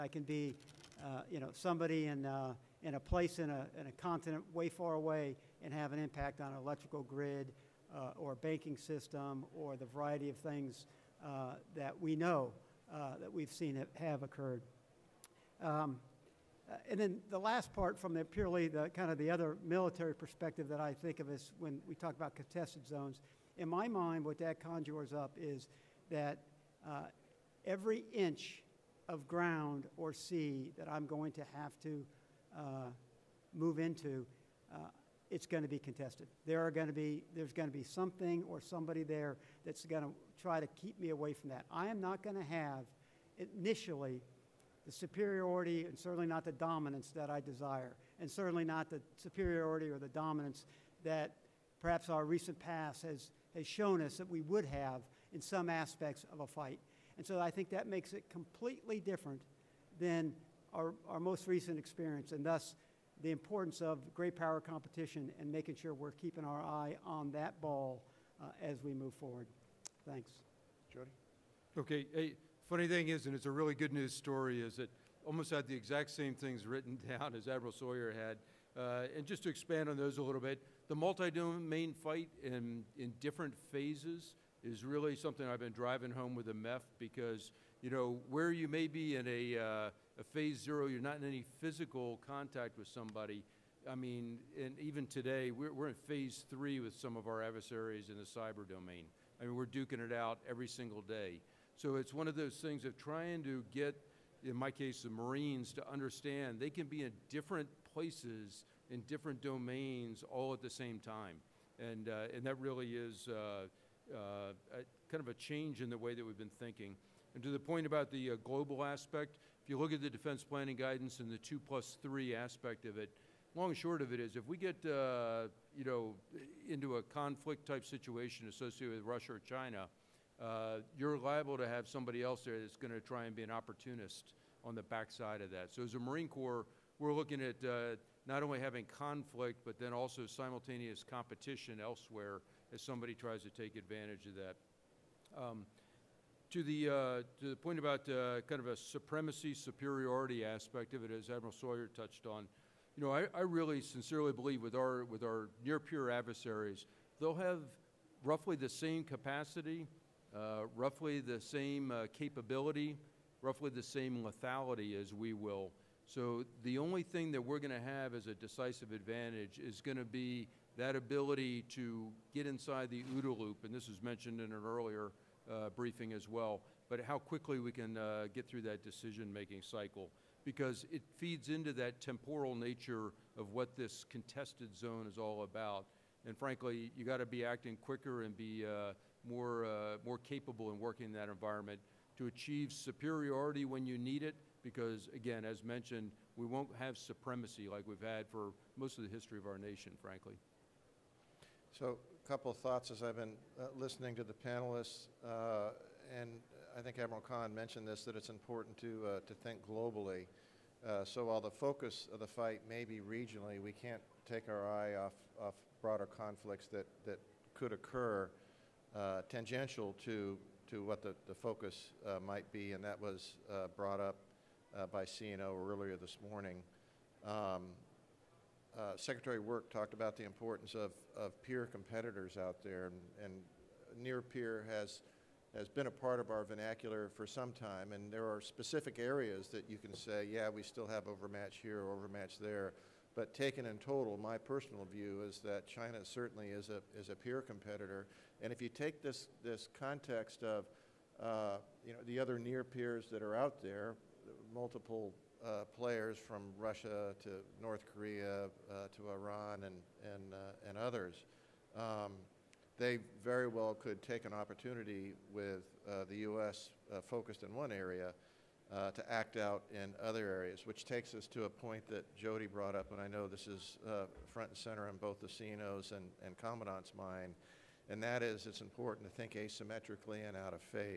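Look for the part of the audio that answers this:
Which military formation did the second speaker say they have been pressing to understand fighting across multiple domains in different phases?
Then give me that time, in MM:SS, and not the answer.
01:26.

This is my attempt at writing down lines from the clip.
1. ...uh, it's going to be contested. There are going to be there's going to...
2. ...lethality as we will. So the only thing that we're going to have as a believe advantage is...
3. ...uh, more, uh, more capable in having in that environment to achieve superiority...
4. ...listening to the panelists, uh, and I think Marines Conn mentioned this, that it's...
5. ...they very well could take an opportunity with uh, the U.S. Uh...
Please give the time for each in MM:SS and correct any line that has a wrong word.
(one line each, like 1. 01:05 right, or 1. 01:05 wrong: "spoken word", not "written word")
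1. 00:34 right
2. 02:44 wrong: "decisive", not "believe"
3. 03:08 wrong: "working", not "having"
4. 03:23 wrong: "Admiral", not "Marines"
5. 04:22 right.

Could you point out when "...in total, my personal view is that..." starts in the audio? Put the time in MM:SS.
04:03.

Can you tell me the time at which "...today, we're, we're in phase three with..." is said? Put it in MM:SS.
01:35.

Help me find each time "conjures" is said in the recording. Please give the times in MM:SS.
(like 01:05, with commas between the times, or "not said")
00:24.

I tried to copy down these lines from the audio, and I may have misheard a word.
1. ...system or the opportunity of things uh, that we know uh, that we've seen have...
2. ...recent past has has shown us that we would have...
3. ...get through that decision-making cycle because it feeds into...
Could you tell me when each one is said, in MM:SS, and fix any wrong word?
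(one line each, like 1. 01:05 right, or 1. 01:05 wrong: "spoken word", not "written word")
1. 00:08 wrong: "variety", not "opportunity"
2. 00:52 right
3. 02:58 right.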